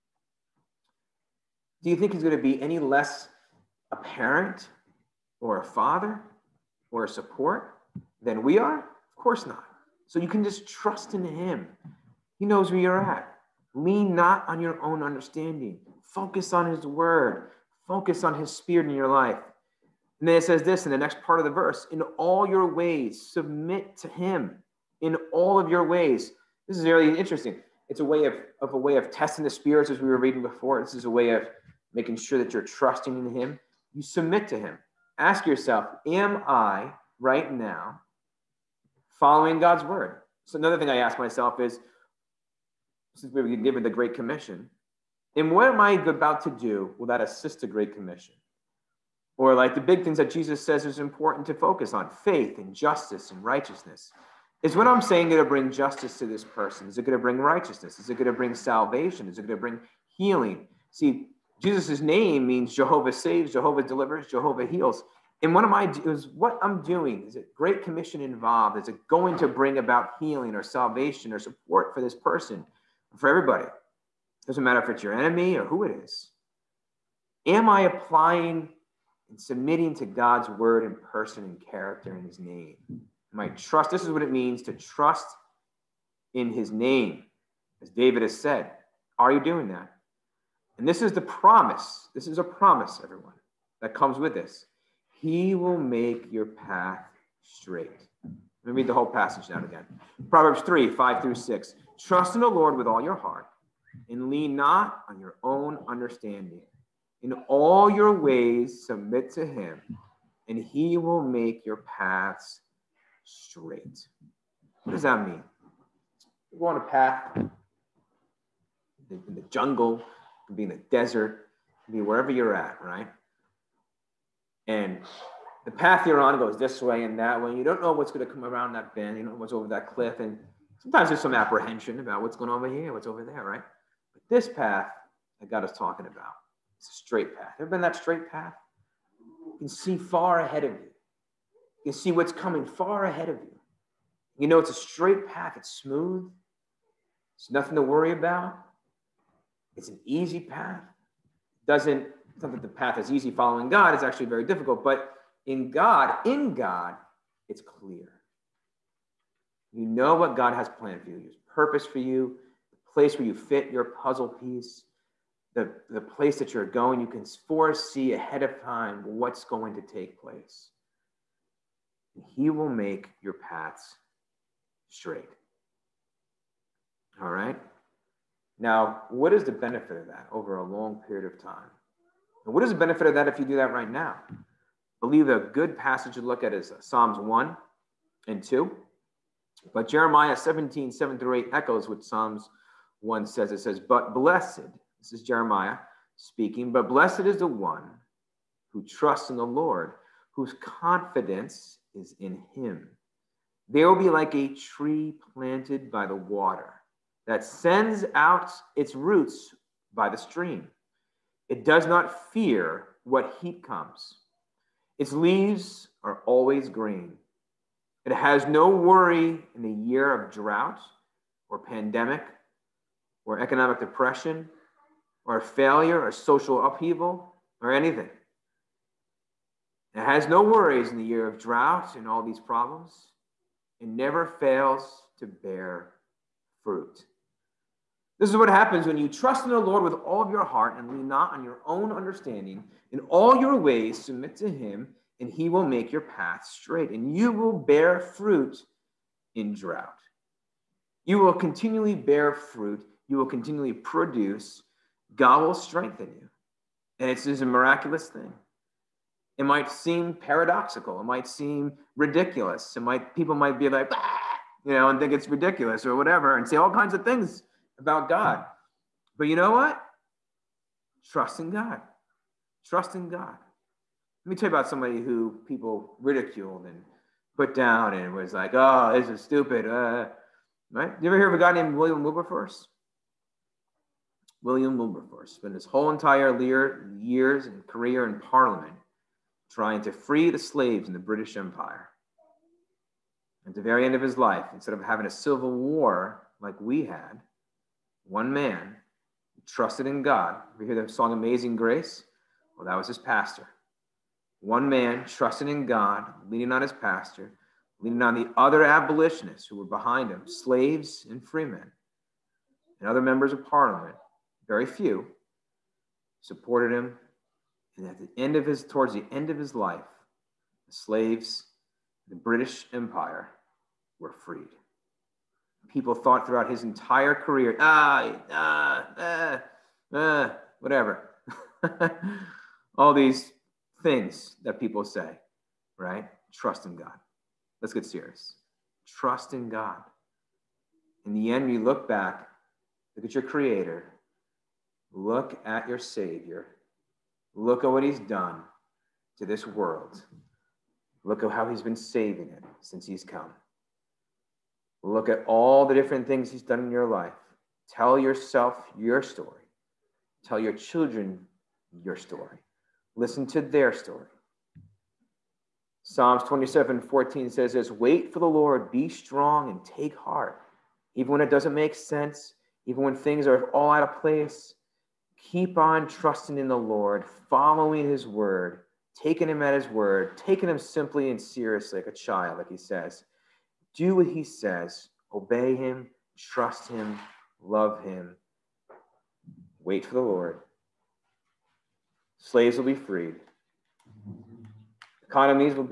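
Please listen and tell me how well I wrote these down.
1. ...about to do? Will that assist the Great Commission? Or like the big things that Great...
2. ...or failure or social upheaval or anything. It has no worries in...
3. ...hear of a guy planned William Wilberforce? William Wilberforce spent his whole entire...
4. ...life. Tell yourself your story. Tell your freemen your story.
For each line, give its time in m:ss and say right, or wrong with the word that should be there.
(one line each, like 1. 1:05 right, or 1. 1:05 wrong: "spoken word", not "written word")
1. 0:45 wrong: "Jesus", not "Great"
2. 3:45 right
3. 4:41 wrong: "named", not "planned"
4. 5:56 wrong: "children", not "freemen".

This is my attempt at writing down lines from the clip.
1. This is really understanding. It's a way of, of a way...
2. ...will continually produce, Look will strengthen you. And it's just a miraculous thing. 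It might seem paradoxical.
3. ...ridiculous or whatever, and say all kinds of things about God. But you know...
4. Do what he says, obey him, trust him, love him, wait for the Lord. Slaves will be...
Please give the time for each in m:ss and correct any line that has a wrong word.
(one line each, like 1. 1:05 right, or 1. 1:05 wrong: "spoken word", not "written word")
1. 0:26 wrong: "interesting", not "understanding"
2. 4:13 wrong: "God", not "Look"
3. 4:25 right
4. 6:23 right.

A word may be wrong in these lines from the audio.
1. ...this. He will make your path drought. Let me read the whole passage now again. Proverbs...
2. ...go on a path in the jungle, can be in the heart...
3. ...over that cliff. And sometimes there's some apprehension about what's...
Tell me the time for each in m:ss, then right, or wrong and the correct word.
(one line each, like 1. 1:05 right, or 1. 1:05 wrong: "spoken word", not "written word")
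1. 1:34 wrong: "straight", not "drought"
2. 1:56 wrong: "desert", not "heart"
3. 2:09 right.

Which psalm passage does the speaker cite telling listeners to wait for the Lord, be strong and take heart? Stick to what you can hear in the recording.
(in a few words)
Psalms 27:14.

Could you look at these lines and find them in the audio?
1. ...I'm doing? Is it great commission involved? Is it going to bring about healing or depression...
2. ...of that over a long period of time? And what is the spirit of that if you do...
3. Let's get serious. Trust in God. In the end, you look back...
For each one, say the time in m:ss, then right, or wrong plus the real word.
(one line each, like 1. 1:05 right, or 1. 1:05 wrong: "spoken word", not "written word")
1. 1:06 wrong: "salvation", not "depression"
2. 2:59 wrong: "benefit", not "spirit"
3. 5:37 right.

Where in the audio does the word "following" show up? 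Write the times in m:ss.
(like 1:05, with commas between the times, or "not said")
0:39, 2:33, 6:17.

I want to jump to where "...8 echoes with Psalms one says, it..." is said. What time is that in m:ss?
3:11.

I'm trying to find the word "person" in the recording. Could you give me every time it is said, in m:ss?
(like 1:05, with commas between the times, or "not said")
0:56, 1:12, 1:20.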